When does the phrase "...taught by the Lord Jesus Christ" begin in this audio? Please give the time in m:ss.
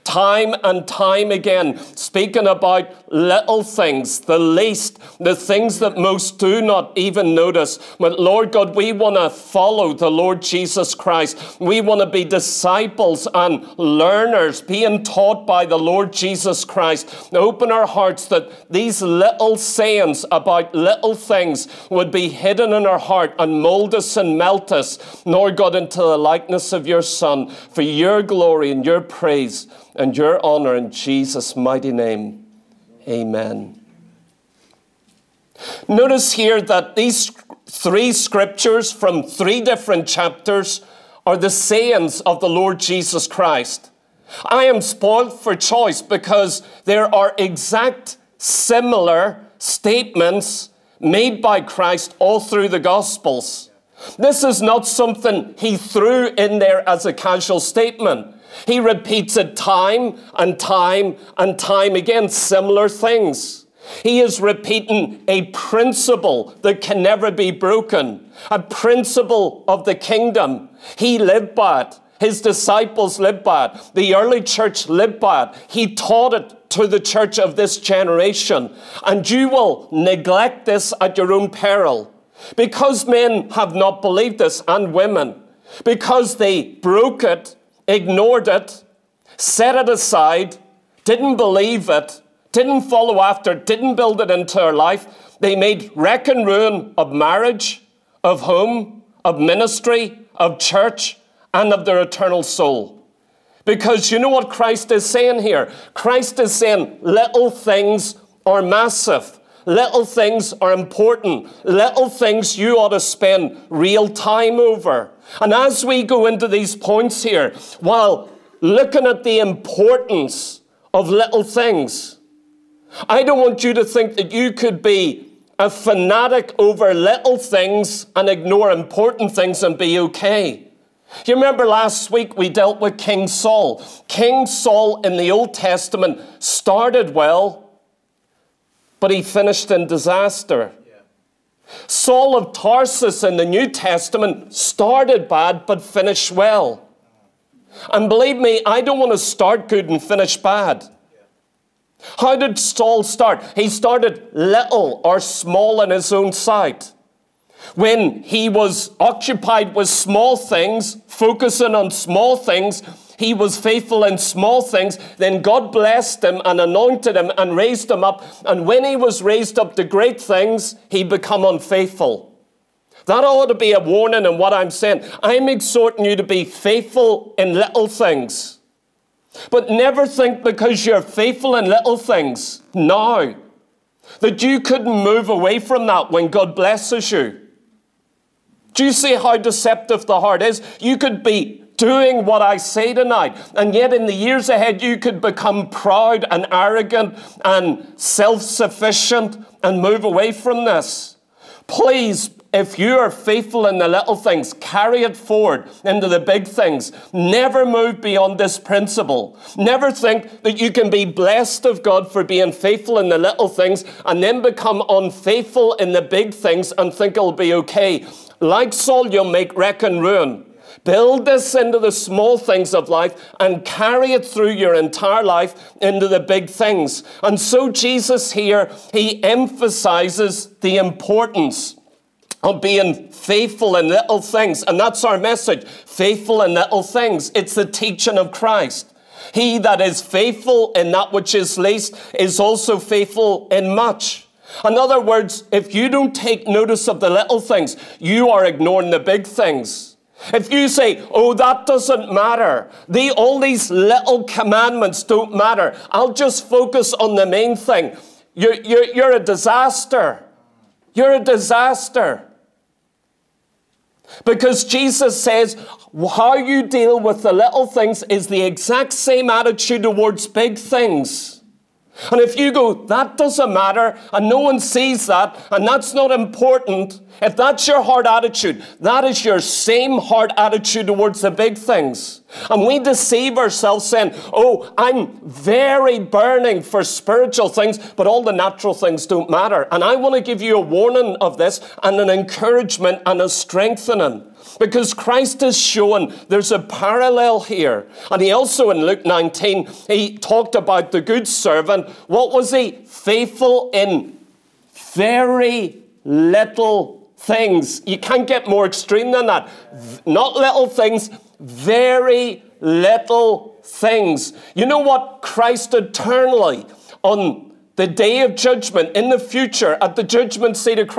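0:15.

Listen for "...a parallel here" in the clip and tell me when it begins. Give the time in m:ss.
4:56.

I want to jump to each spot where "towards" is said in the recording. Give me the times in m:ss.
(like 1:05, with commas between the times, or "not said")
4:29, 4:40.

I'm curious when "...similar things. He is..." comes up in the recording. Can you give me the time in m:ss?
1:02.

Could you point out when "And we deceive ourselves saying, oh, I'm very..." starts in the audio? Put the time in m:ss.
4:42.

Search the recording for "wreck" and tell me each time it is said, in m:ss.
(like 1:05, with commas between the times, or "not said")
1:35, 3:39.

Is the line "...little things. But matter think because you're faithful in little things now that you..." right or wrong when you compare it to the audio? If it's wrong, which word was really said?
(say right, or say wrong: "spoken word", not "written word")
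wrong: "never", not "matter".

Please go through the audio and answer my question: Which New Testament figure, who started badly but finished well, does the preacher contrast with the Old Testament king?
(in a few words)
Saul of Tarsus.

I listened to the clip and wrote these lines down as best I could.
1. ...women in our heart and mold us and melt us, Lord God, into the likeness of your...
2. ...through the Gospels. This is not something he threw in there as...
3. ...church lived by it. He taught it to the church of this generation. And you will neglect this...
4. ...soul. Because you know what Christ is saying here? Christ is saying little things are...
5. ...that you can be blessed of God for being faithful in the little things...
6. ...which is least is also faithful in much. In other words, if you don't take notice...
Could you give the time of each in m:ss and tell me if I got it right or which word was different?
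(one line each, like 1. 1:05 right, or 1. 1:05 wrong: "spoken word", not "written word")
1. 0:22 wrong: "hidden", not "women"
2. 0:52 right
3. 1:14 right
4. 1:42 right
5. 3:30 right
6. 4:01 right.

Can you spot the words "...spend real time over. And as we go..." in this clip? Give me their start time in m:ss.
1:53.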